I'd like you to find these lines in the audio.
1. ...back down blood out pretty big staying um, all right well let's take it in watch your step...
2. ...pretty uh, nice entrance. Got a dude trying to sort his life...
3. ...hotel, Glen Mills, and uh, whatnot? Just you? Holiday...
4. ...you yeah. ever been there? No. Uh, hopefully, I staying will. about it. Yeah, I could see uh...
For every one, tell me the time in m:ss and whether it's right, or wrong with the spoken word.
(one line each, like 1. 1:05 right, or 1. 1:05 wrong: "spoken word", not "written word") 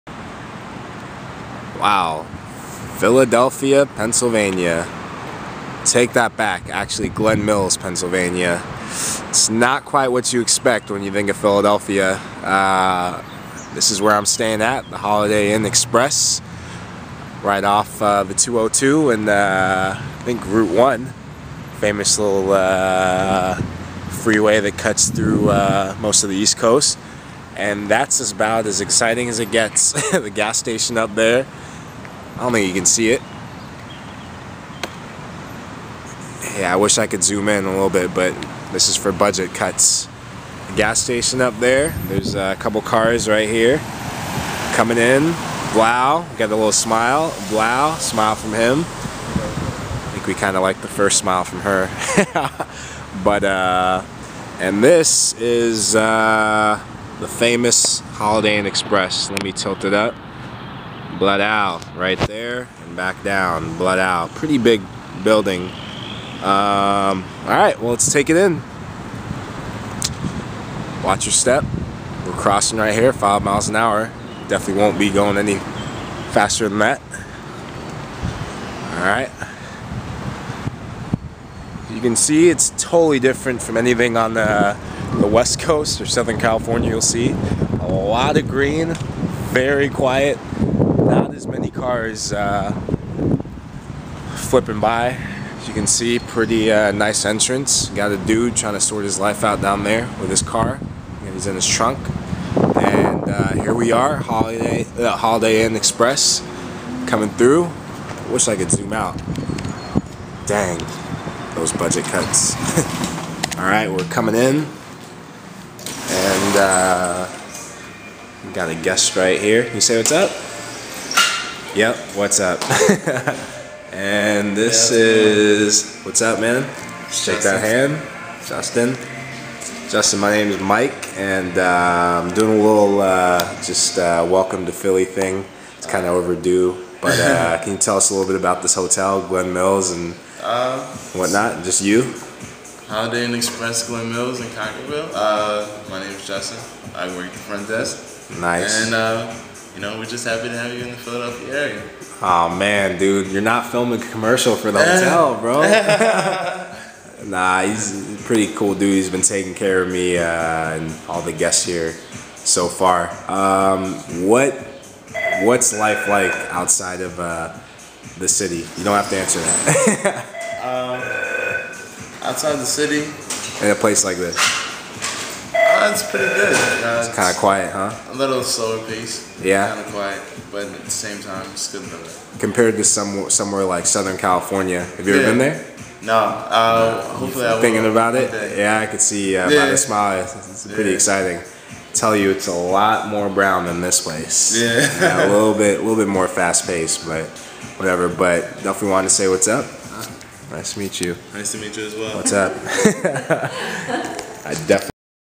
1. 1:02 wrong: "building", not "staying"
2. 1:36 right
3. 2:18 right
4. 3:05 wrong: "thinking", not "staying".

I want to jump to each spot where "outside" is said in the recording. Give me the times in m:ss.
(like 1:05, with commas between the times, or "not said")
2:46, 2:52.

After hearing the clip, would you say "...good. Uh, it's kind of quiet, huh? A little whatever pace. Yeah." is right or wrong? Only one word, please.
wrong.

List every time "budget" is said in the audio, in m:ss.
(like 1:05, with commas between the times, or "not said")
0:39, 1:51.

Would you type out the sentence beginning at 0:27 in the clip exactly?
And that's about as exciting as it gets.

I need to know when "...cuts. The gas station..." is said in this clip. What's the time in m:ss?
0:39.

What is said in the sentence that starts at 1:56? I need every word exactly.
And uh, got a guest right here.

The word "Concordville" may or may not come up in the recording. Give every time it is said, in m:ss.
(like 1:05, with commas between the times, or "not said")
2:24.